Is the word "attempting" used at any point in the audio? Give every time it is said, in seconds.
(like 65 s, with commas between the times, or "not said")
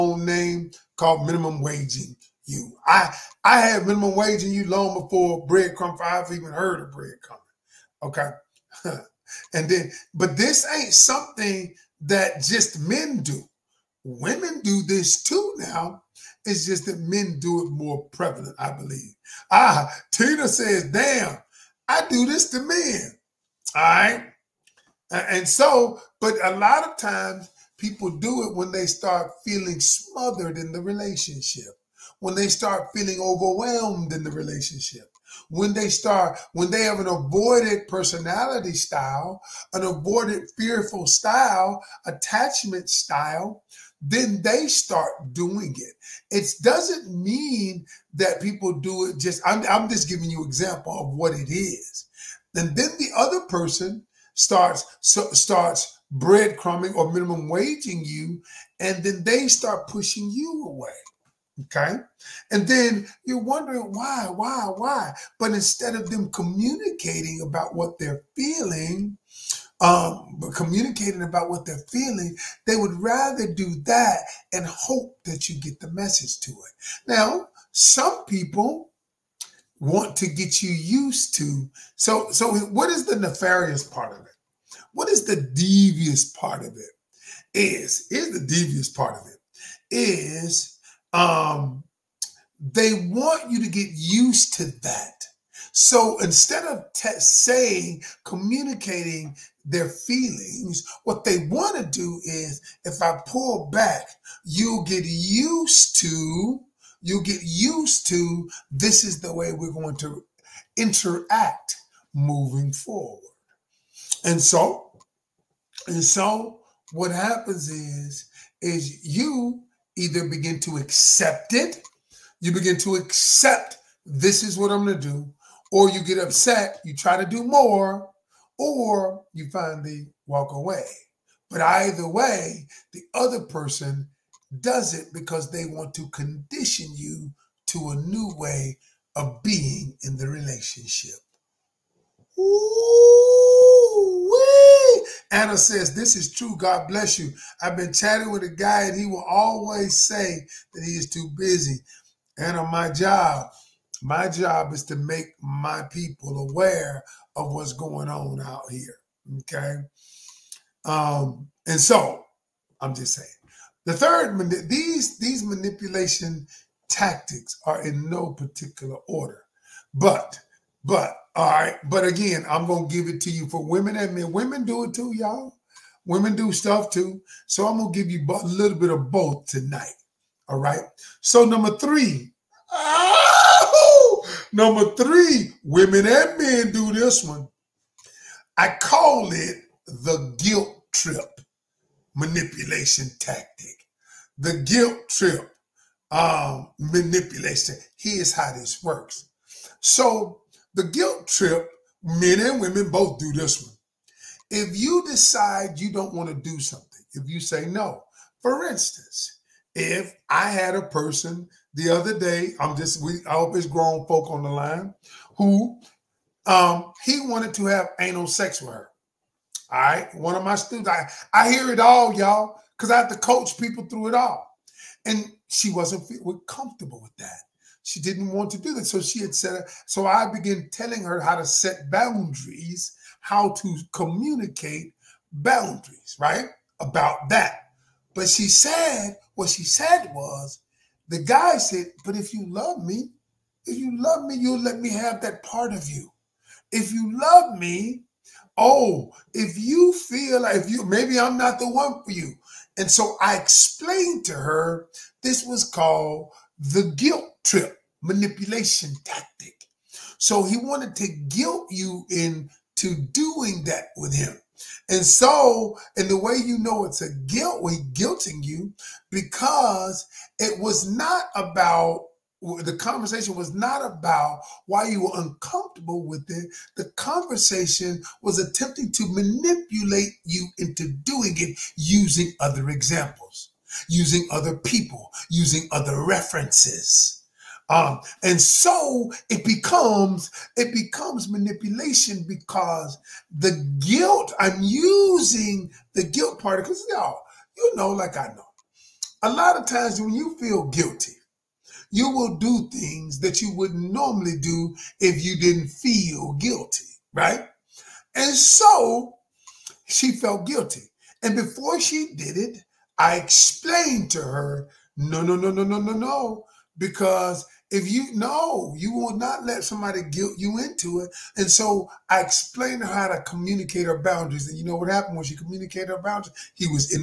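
278 s.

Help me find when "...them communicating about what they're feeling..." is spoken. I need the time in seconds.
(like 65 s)
66 s.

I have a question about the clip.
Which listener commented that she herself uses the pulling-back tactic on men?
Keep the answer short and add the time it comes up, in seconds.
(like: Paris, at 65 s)
Tina, at 20 s.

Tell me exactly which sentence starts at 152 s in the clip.
Anna, my job my job is to make my people aware of what's going on out here.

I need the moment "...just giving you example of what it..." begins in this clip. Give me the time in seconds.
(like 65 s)
49 s.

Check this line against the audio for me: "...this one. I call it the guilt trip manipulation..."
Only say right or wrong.
right.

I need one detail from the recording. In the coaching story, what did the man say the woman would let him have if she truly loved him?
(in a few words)
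That part of you.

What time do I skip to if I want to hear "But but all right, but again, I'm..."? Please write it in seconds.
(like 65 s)
169 s.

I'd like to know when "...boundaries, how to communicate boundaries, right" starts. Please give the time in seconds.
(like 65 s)
231 s.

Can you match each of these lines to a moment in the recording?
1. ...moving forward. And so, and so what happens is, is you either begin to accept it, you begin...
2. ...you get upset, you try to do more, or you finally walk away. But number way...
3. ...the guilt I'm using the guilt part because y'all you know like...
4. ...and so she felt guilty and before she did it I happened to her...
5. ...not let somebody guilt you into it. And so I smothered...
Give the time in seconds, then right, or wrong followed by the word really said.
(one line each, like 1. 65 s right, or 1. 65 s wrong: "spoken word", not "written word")
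1. 112 s right
2. 125 s wrong: "either", not "number"
3. 293 s right
4. 308 s wrong: "explained", not "happened"
5. 319 s wrong: "explained", not "smothered".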